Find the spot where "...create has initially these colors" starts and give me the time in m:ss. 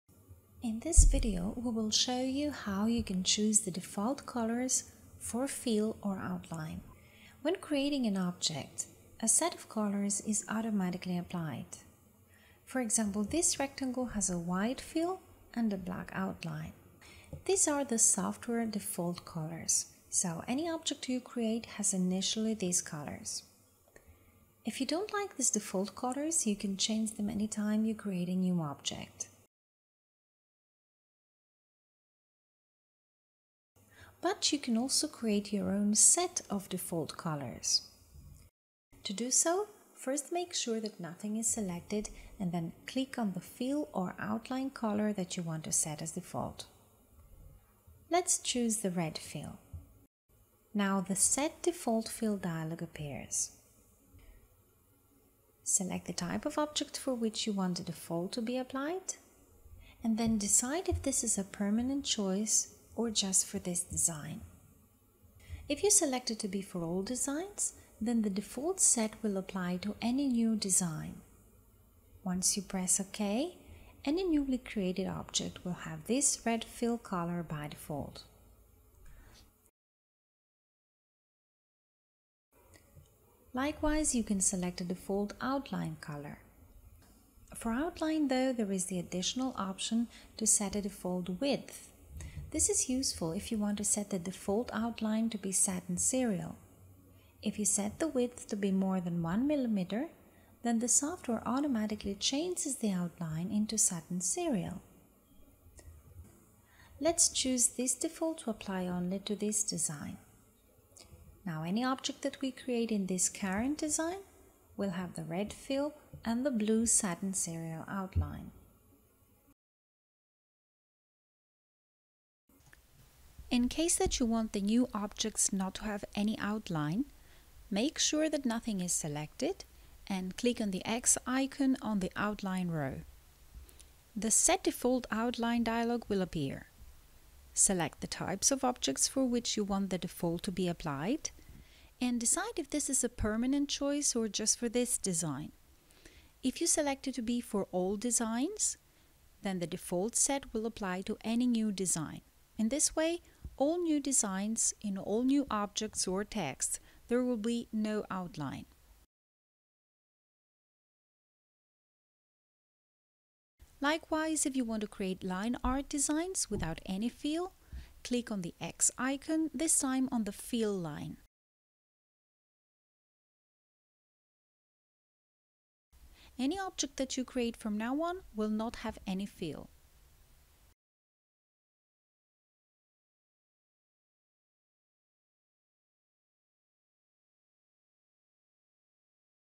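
0:21.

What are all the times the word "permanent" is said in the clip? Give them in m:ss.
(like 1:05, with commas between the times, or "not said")
1:01, 2:23.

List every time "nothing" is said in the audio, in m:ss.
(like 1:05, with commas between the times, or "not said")
0:40, 2:08.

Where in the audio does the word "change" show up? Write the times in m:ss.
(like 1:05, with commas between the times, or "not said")
0:26, 1:42.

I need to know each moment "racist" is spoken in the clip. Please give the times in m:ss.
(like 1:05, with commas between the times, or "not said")
not said.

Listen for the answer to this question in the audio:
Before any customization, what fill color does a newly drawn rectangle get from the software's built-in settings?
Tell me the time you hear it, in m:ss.
0:14.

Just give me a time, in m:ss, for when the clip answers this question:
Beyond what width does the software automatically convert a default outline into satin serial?
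1:39.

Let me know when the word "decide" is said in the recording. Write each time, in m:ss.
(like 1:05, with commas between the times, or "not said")
1:00, 2:22.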